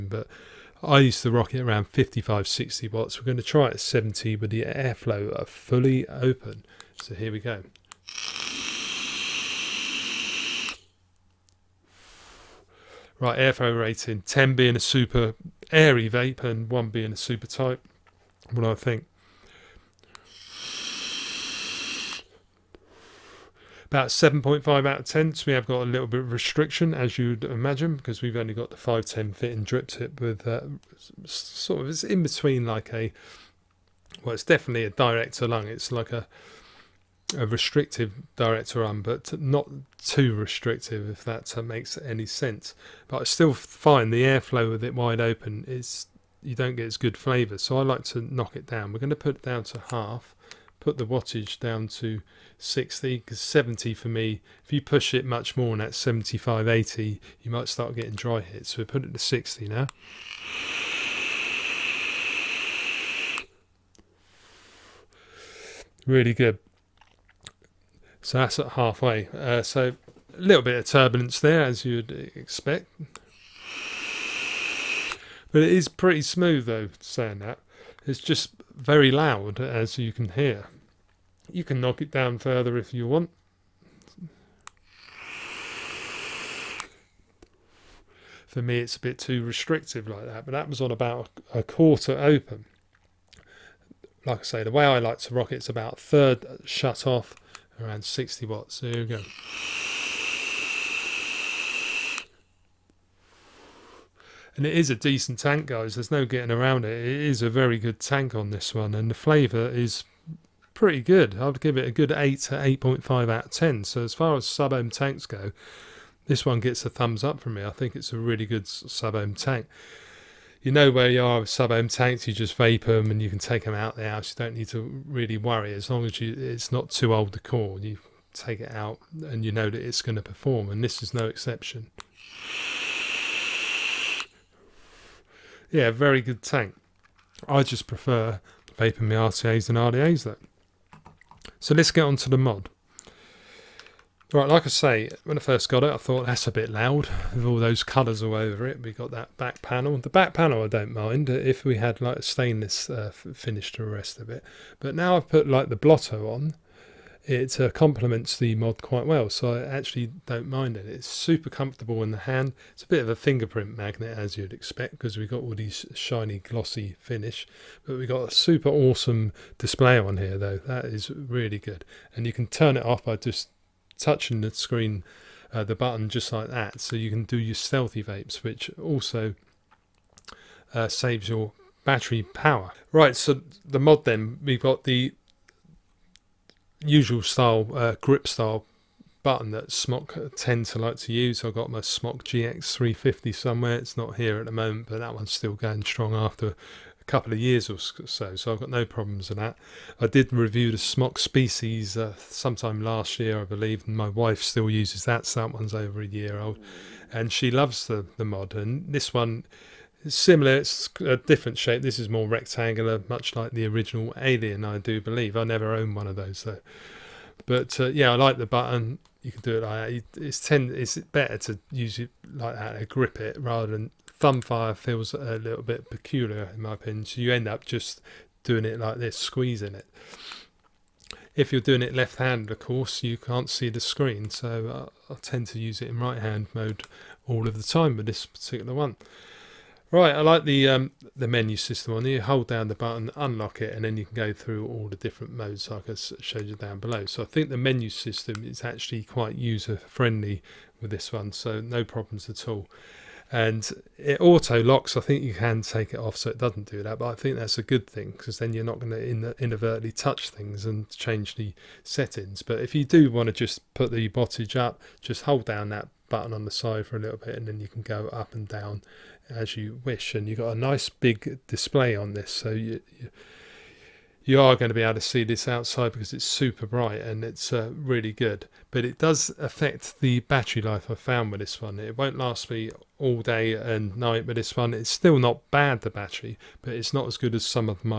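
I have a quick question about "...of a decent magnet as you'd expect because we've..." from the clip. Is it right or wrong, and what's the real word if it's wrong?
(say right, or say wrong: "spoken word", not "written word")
wrong: "fingerprint", not "decent".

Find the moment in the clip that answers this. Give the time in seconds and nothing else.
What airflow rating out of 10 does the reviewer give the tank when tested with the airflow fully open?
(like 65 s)
23 s.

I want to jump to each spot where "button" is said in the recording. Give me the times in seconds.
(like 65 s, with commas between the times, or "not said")
175 s, 189 s, 218 s, 242 s, 266 s.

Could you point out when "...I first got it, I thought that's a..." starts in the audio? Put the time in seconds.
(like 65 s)
145 s.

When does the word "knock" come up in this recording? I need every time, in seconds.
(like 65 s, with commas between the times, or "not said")
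48 s, 81 s.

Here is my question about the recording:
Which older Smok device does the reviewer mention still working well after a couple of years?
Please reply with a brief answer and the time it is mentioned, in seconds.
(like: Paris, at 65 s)
Smok GX350, at 191 s.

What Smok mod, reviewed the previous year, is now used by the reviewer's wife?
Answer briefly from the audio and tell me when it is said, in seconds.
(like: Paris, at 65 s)
Smok Species, at 200 s.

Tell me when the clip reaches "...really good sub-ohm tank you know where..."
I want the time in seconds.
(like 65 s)
118 s.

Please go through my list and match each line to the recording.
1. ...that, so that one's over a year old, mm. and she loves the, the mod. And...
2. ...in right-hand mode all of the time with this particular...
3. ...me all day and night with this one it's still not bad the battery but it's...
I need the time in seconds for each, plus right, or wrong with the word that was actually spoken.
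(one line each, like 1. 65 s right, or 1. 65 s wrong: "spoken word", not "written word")
1. 205 s right
2. 235 s right
3. 282 s right.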